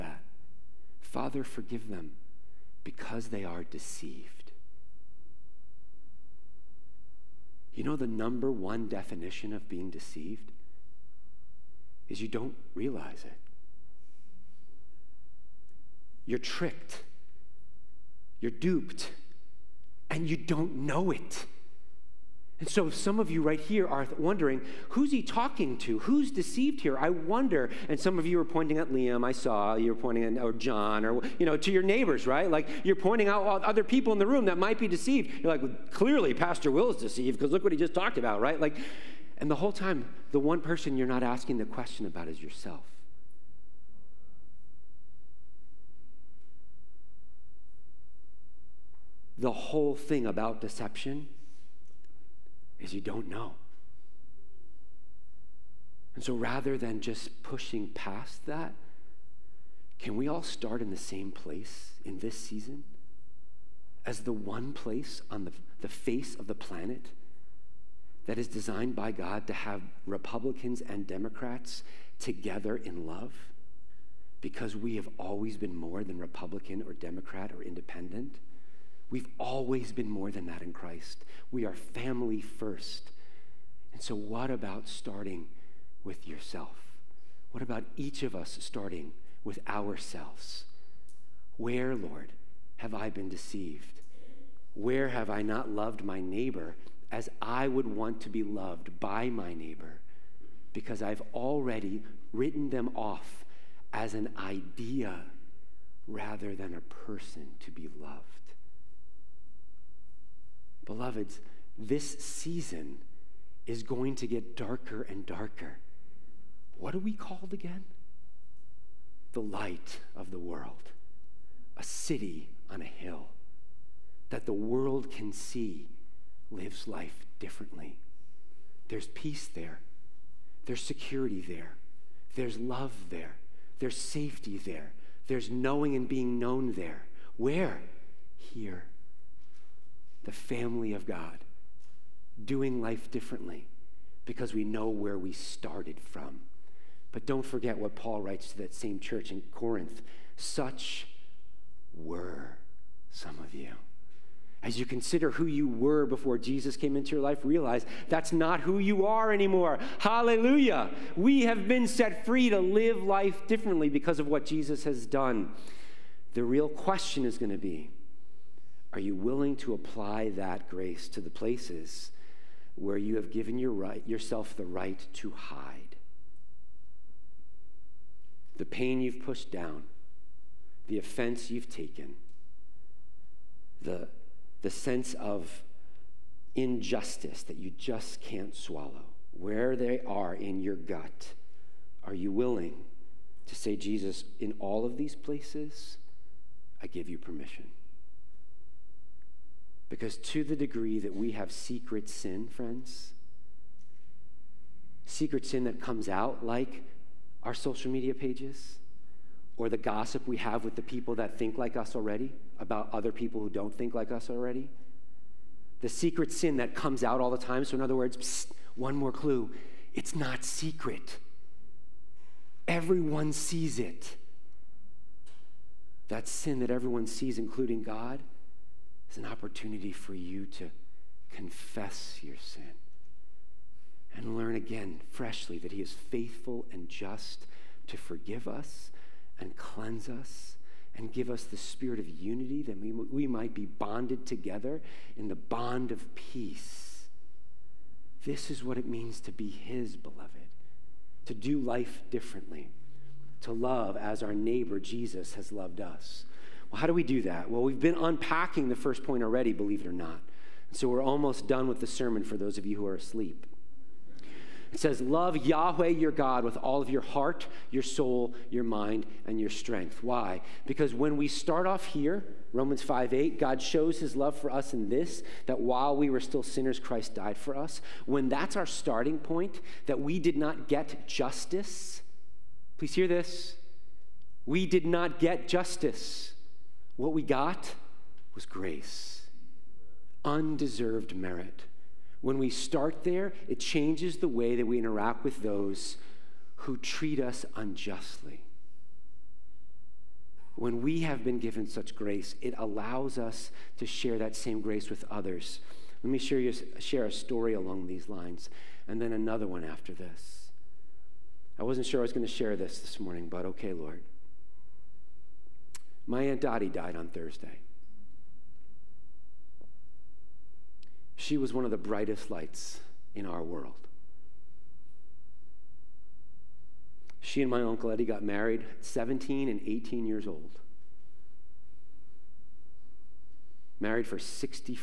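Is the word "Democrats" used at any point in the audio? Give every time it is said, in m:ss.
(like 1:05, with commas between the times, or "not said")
1:11, 1:16.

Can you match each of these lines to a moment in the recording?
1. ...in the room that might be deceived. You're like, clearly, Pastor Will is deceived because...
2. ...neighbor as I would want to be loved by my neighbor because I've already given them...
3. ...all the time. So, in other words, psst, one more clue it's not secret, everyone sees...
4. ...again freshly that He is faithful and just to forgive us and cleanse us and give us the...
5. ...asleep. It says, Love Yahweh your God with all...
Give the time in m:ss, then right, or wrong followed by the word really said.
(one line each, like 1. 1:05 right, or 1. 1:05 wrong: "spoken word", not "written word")
1. 0:34 right
2. 1:36 wrong: "written", not "given"
3. 3:37 right
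4. 3:54 right
5. 4:22 right.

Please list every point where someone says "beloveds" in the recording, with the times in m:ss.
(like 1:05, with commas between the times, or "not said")
1:50, 4:09.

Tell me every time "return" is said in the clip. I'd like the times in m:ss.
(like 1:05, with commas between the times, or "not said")
not said.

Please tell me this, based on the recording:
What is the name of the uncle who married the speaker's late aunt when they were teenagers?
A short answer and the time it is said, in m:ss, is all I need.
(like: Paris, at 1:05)
Uncle Eddie, at 5:27.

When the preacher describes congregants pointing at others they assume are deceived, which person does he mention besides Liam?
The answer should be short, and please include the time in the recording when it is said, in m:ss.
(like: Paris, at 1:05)
John, at 0:30.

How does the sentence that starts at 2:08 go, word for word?
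There's peace there, there's security there, there's love there, there's safety there, there's knowing and being known there.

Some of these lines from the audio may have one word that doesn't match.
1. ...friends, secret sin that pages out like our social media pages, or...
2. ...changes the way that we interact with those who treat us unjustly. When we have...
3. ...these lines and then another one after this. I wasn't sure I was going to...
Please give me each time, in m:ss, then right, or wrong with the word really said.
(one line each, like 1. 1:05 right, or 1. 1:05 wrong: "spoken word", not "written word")
1. 3:22 wrong: "comes", not "pages"
2. 4:53 right
3. 5:07 right.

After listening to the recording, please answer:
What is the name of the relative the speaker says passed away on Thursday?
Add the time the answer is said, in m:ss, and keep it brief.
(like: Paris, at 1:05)
Aunt Dottie, at 5:16.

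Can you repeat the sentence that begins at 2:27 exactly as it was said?
But don't forget what Paul writes to that same church in Corinth.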